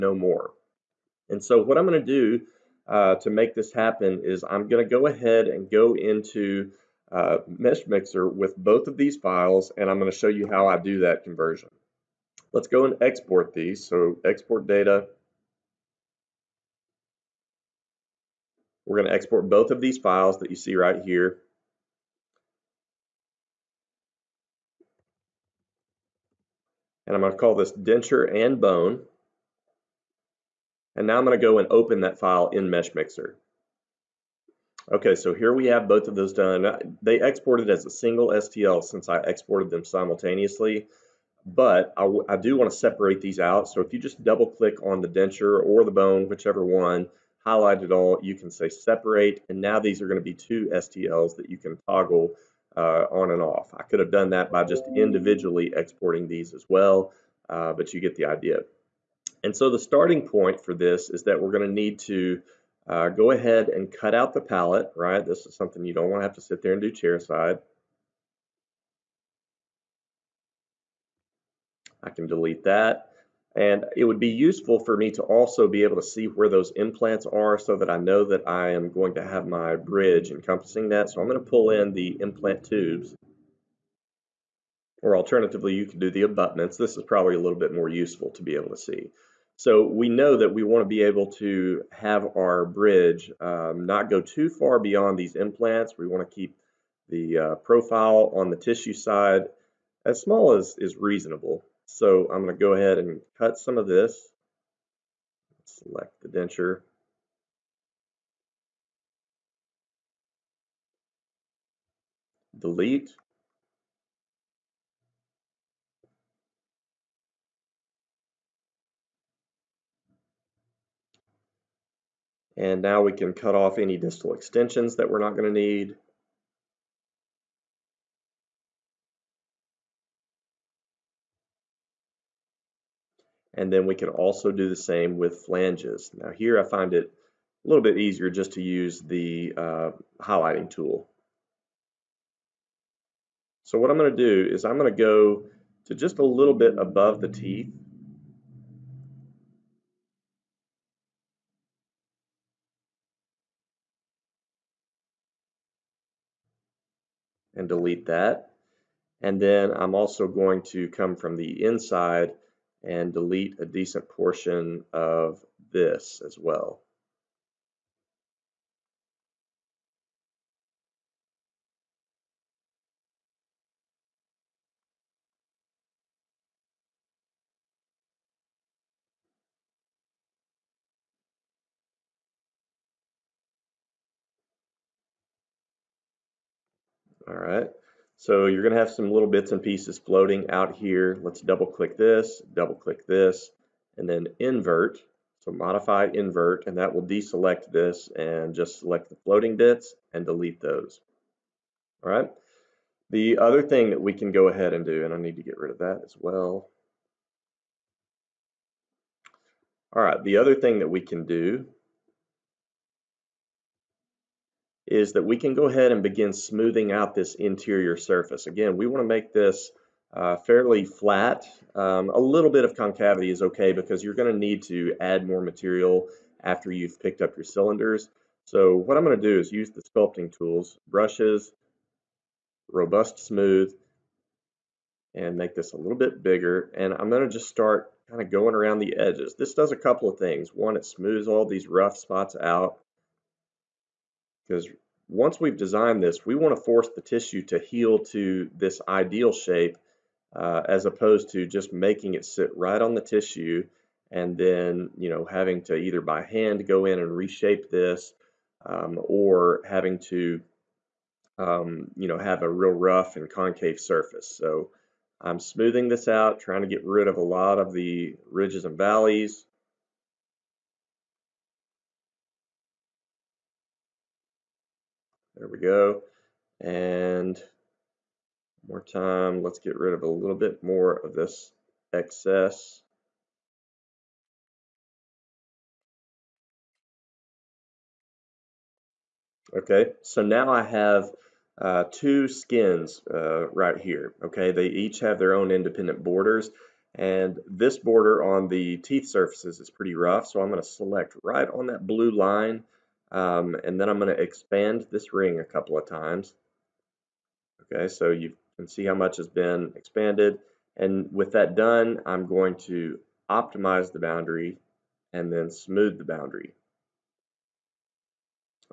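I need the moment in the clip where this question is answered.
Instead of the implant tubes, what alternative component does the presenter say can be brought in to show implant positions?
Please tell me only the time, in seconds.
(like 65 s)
86 s.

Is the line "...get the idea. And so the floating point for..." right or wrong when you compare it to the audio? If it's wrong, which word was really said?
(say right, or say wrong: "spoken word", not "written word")
wrong: "starting", not "floating".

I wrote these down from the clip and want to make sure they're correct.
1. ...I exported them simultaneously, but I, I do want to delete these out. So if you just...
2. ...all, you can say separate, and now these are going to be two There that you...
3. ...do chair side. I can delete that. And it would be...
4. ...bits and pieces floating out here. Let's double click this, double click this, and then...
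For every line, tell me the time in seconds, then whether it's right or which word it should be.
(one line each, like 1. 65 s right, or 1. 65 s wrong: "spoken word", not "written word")
1. 39 s wrong: "separate", not "delete"
2. 47 s wrong: "STLs", not "There"
3. 66 s right
4. 189 s right.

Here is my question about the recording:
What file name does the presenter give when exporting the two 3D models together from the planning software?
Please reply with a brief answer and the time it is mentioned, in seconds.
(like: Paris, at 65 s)
denture and bone, at 27 s.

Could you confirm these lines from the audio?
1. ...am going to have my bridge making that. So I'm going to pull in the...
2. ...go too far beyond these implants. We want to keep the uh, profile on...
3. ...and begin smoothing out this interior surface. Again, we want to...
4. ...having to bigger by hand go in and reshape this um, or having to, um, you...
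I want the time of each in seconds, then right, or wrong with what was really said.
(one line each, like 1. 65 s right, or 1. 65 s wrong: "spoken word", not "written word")
1. 78 s wrong: "encompassing", not "making"
2. 94 s right
3. 215 s right
4. 255 s wrong: "either", not "bigger".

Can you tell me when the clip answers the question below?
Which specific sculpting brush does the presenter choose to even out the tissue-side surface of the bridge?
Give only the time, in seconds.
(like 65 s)
232 s.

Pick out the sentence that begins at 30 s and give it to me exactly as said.
And now I'm going to go and open that file in Meshmixer.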